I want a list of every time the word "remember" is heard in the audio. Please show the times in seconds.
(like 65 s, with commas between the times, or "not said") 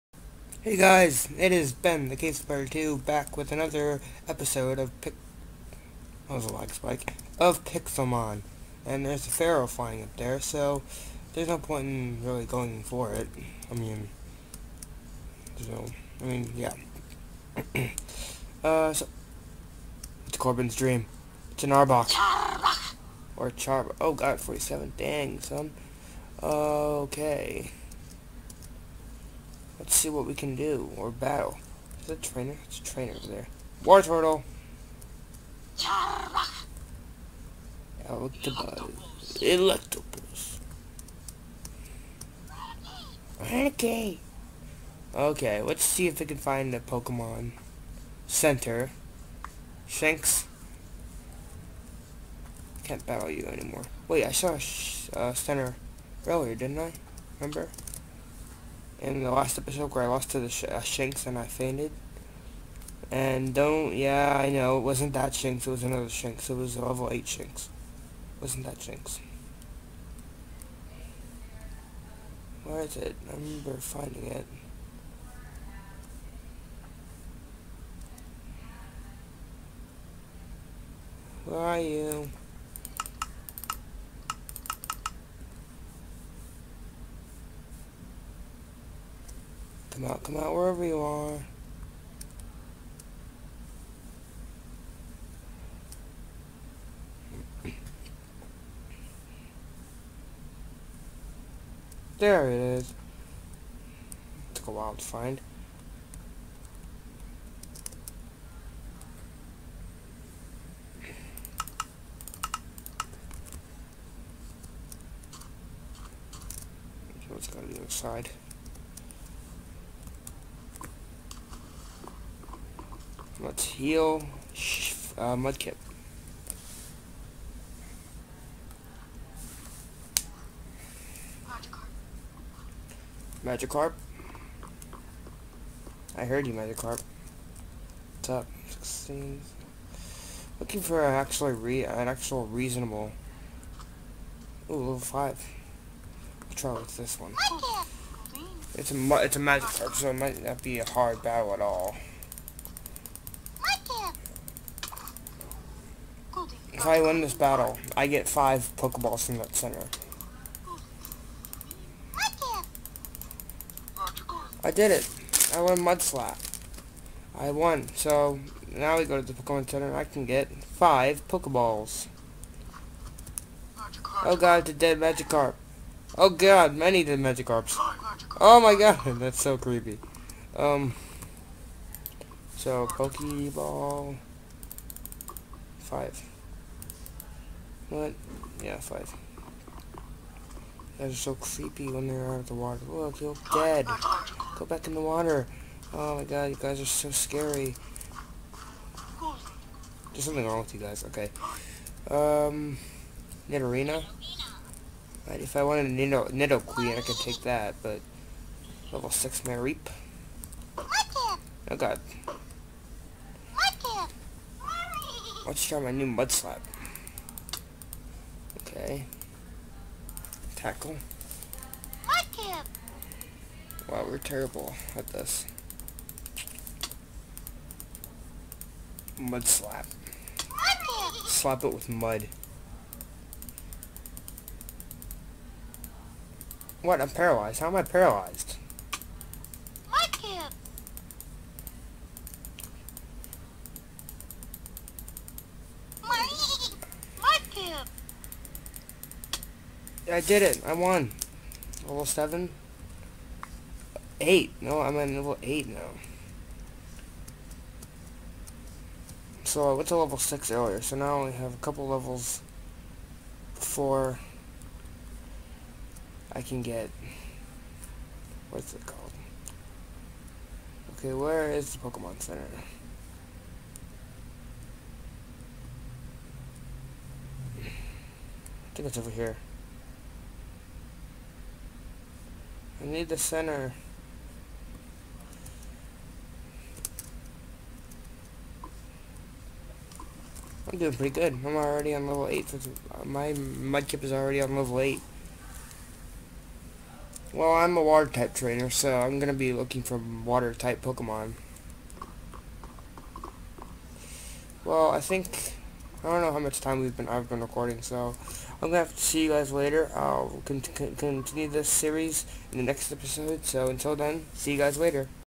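57 s, 73 s.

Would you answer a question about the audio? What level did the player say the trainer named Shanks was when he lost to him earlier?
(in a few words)
8.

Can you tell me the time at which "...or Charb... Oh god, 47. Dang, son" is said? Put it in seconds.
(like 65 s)
23 s.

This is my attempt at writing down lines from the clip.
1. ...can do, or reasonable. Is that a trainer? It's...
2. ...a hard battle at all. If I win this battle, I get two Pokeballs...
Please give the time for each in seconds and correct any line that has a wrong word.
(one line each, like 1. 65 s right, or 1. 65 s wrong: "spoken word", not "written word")
1. 30 s wrong: "battle", not "reasonable"
2. 150 s wrong: "five", not "two".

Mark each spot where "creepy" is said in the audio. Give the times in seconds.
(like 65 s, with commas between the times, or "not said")
179 s, 191 s.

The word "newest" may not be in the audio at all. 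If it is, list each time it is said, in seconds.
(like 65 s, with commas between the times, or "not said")
not said.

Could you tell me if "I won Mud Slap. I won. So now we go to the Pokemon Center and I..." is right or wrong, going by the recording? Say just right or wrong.
right.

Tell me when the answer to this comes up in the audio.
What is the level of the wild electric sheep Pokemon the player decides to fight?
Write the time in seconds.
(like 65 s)
208 s.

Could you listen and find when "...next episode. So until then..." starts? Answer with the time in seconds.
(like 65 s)
312 s.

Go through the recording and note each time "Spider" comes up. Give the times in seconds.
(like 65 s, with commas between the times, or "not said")
2 s.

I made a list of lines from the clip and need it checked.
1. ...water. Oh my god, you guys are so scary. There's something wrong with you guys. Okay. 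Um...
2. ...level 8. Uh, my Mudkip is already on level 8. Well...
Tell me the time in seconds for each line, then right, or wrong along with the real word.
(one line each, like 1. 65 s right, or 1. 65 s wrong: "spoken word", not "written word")
1. 195 s right
2. 292 s right.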